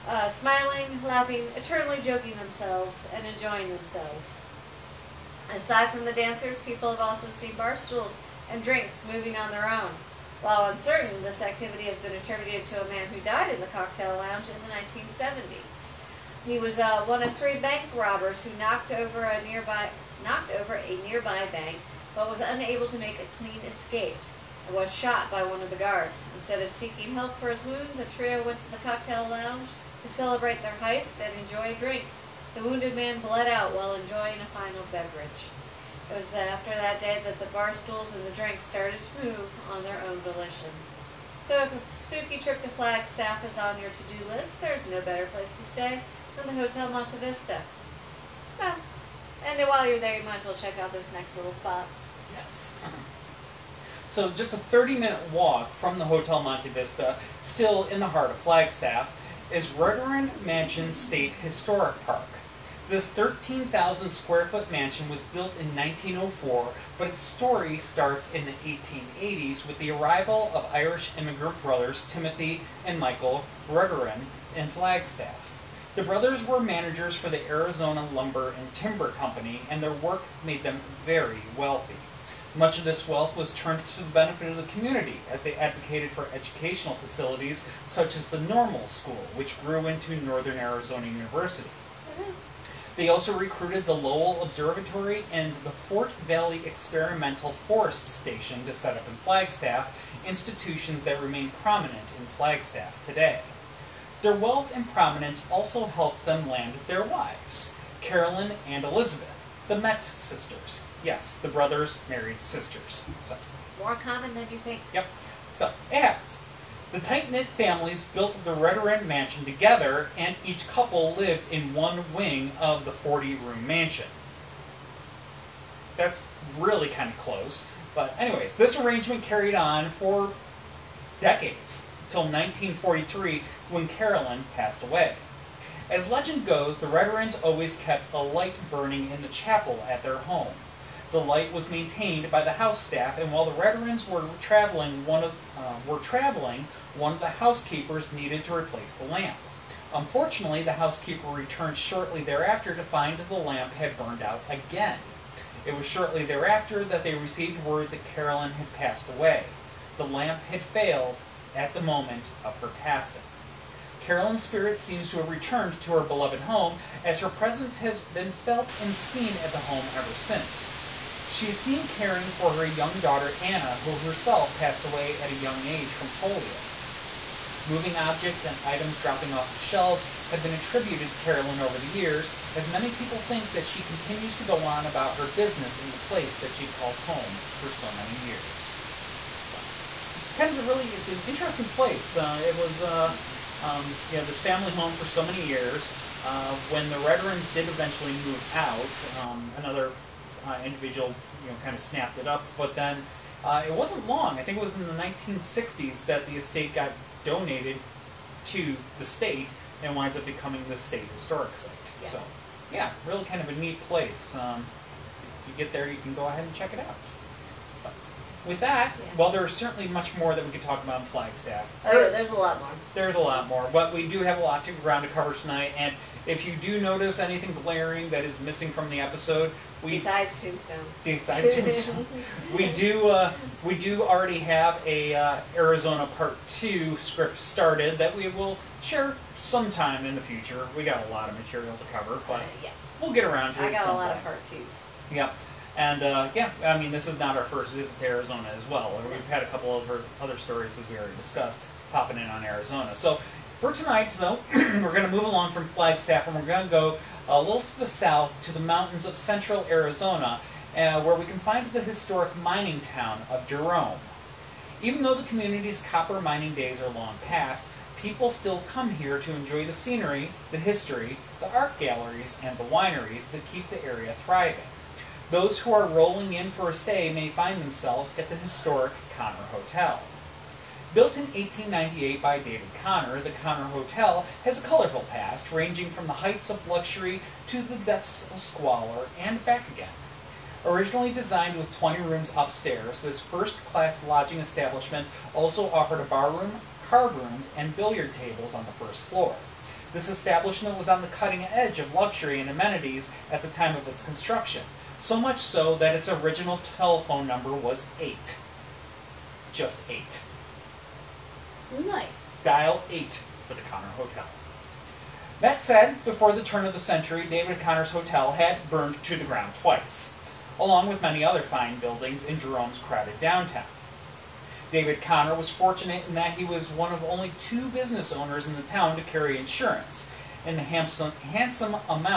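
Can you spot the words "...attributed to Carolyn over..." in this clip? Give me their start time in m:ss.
3:00.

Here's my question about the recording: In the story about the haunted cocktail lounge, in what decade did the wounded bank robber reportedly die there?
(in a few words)
1970s.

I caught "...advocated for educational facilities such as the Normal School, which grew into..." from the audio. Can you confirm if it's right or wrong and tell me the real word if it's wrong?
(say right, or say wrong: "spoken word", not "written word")
right.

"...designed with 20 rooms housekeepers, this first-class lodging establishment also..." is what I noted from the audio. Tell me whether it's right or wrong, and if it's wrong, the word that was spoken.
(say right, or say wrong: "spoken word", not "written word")
wrong: "upstairs", not "housekeepers".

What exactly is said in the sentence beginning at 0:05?
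Aside from the dancers, people have also seen bar stools and drinks moving on their own.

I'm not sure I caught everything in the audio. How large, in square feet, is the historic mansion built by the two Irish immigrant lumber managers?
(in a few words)
13,000.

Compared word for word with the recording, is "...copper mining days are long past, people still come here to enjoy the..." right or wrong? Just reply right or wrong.
right.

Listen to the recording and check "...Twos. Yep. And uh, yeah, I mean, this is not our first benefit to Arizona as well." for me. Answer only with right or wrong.
wrong.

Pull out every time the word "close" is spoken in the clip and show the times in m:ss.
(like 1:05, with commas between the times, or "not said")
2:07.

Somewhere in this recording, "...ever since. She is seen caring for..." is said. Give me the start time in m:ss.
2:49.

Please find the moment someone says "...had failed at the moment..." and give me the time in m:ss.
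2:40.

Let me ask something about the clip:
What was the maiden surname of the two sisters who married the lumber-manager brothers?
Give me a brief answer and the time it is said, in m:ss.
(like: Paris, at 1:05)
Metz, at 1:49.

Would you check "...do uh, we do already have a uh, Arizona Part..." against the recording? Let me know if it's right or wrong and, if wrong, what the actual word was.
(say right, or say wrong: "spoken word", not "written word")
right.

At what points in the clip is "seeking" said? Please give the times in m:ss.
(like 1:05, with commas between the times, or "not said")
0:26.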